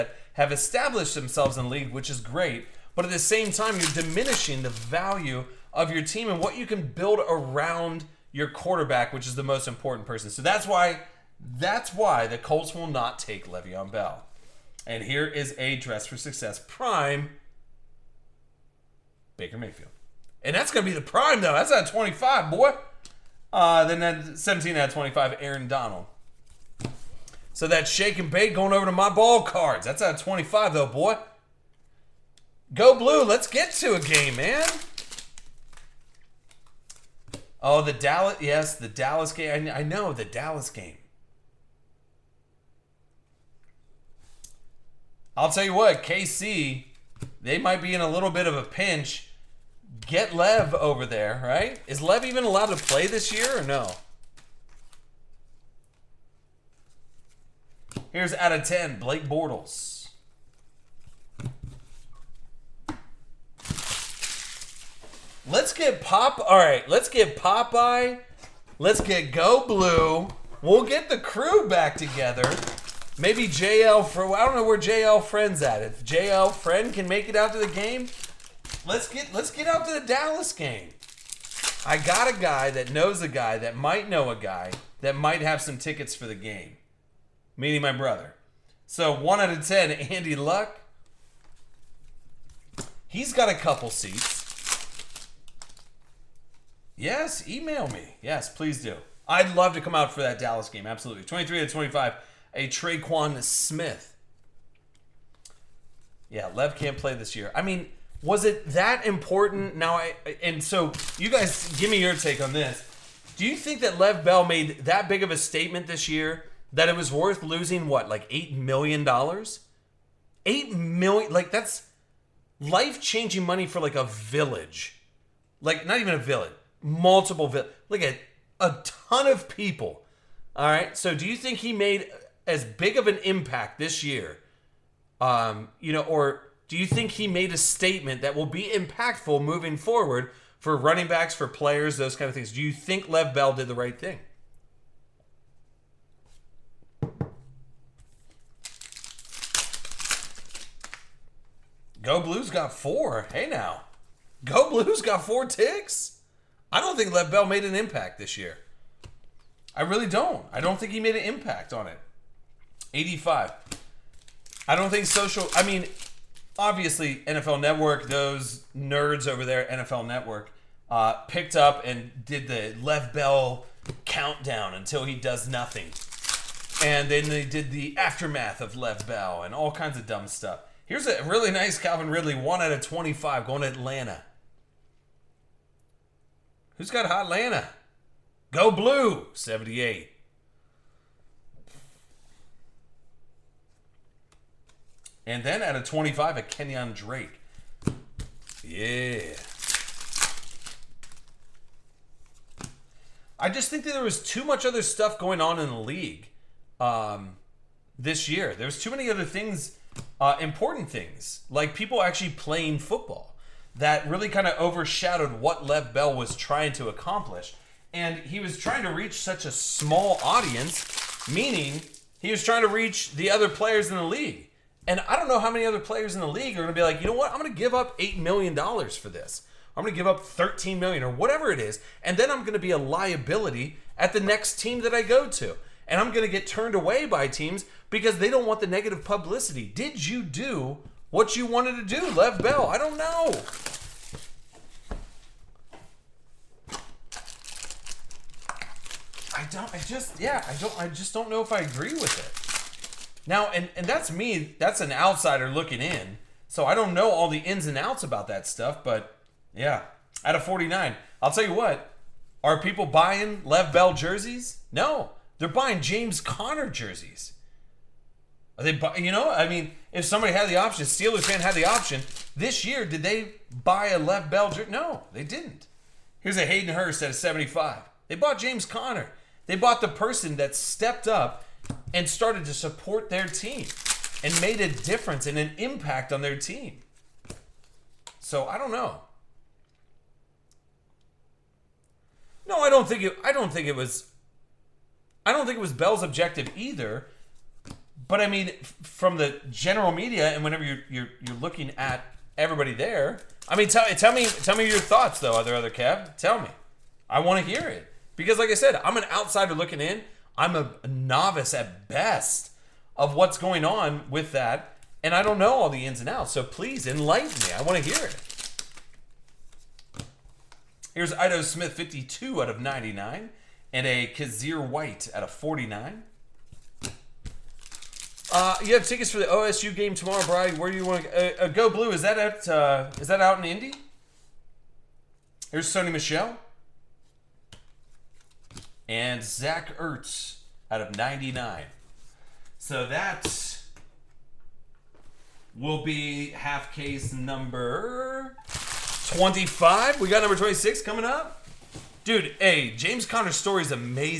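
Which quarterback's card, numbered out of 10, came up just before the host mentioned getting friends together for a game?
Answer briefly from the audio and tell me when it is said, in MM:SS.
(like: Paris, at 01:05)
Blake Bortles, at 00:58.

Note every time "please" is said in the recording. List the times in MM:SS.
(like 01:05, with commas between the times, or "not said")
01:38, 05:16.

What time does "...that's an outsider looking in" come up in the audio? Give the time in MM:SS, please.
04:14.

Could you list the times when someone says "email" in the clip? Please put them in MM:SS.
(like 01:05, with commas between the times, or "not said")
01:37.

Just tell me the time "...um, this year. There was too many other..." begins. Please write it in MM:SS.
03:26.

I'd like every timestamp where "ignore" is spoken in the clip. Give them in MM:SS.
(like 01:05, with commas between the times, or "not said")
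not said.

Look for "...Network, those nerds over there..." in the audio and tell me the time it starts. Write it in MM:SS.
02:47.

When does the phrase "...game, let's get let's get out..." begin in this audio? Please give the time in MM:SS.
01:17.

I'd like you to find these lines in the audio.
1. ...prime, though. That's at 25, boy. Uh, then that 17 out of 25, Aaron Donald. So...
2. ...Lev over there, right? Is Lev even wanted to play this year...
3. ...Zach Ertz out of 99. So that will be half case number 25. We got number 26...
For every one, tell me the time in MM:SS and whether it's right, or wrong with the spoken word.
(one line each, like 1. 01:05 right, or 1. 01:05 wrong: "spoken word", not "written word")
1. 00:21 right
2. 00:50 wrong: "allowed", not "wanted"
3. 05:39 right.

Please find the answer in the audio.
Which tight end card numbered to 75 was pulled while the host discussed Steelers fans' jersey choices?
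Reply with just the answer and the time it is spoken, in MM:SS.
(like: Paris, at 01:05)
Hayden Hurst, at 04:36.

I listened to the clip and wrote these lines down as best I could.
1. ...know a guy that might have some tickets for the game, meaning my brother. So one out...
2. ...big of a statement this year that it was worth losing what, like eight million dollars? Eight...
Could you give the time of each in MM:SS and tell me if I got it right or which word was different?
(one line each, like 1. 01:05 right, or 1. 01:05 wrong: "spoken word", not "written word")
1. 01:24 right
2. 01:55 right.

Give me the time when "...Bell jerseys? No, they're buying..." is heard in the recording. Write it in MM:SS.
04:23.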